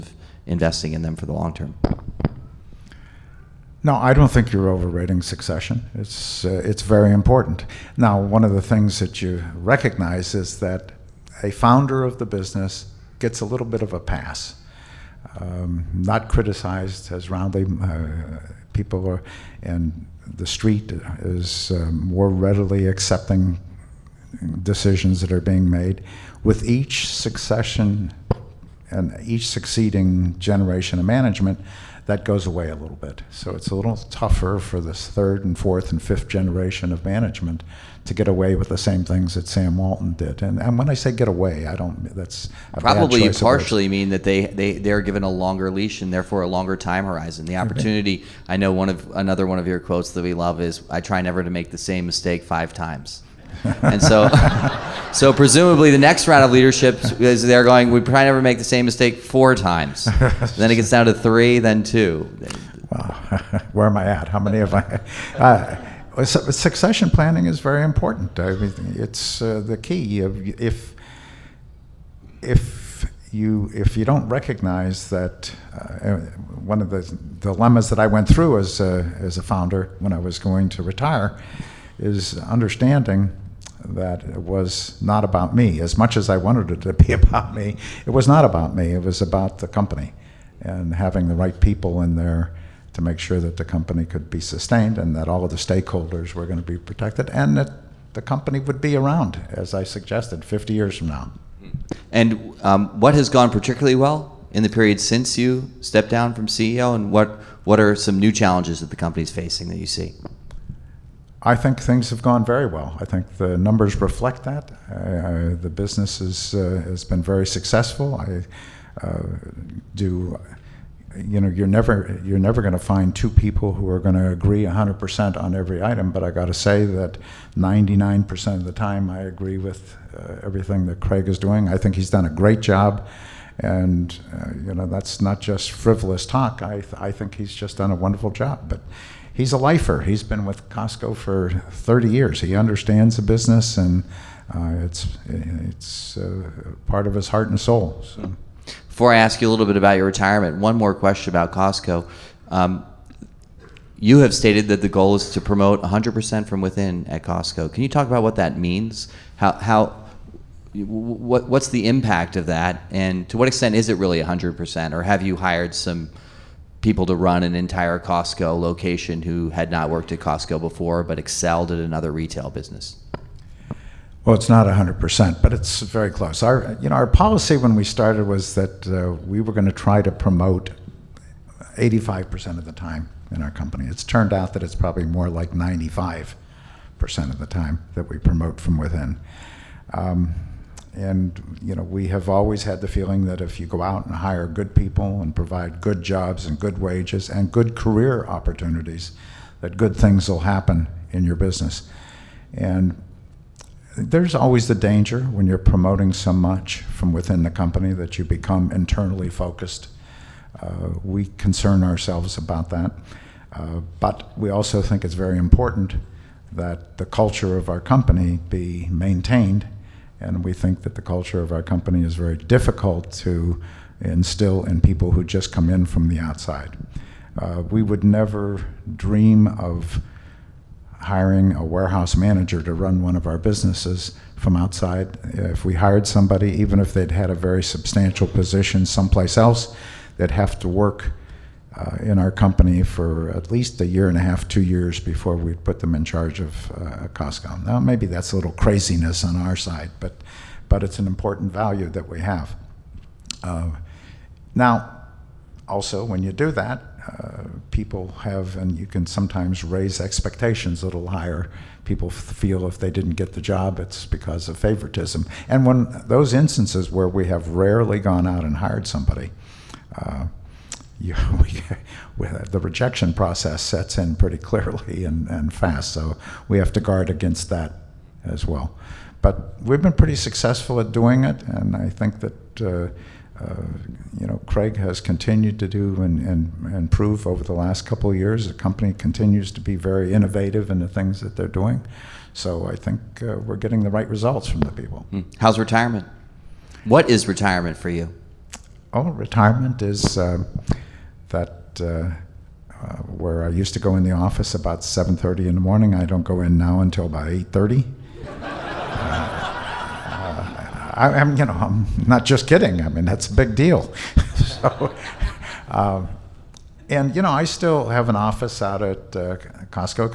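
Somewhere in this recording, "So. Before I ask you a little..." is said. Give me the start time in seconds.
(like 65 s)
148 s.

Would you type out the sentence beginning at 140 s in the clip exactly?
He's been with Costco for 30 years.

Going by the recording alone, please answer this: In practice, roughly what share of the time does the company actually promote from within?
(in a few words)
95%.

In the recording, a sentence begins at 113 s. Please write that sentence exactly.
I think the numbers reflect that.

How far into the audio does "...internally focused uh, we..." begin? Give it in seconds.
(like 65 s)
208 s.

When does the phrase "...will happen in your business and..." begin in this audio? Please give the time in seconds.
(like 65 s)
200 s.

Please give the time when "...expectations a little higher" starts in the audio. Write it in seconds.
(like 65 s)
259 s.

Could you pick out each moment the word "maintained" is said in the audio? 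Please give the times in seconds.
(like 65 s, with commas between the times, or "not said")
218 s.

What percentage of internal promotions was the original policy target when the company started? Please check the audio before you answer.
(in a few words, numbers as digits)
85%.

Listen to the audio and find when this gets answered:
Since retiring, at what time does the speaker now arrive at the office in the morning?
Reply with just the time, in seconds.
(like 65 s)
307 s.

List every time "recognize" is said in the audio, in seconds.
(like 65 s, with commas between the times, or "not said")
9 s, 74 s.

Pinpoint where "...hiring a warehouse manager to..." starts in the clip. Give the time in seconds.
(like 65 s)
231 s.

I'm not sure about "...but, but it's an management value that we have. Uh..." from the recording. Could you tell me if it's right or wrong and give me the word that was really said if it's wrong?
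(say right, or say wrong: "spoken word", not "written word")
wrong: "important", not "management".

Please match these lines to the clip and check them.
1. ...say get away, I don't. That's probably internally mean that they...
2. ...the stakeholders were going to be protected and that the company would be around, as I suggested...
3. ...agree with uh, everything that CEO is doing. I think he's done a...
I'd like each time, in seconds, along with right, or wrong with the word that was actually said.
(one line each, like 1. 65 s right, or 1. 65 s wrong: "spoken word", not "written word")
1. 40 s wrong: "partially", not "internally"
2. 95 s right
3. 129 s wrong: "Craig", not "CEO".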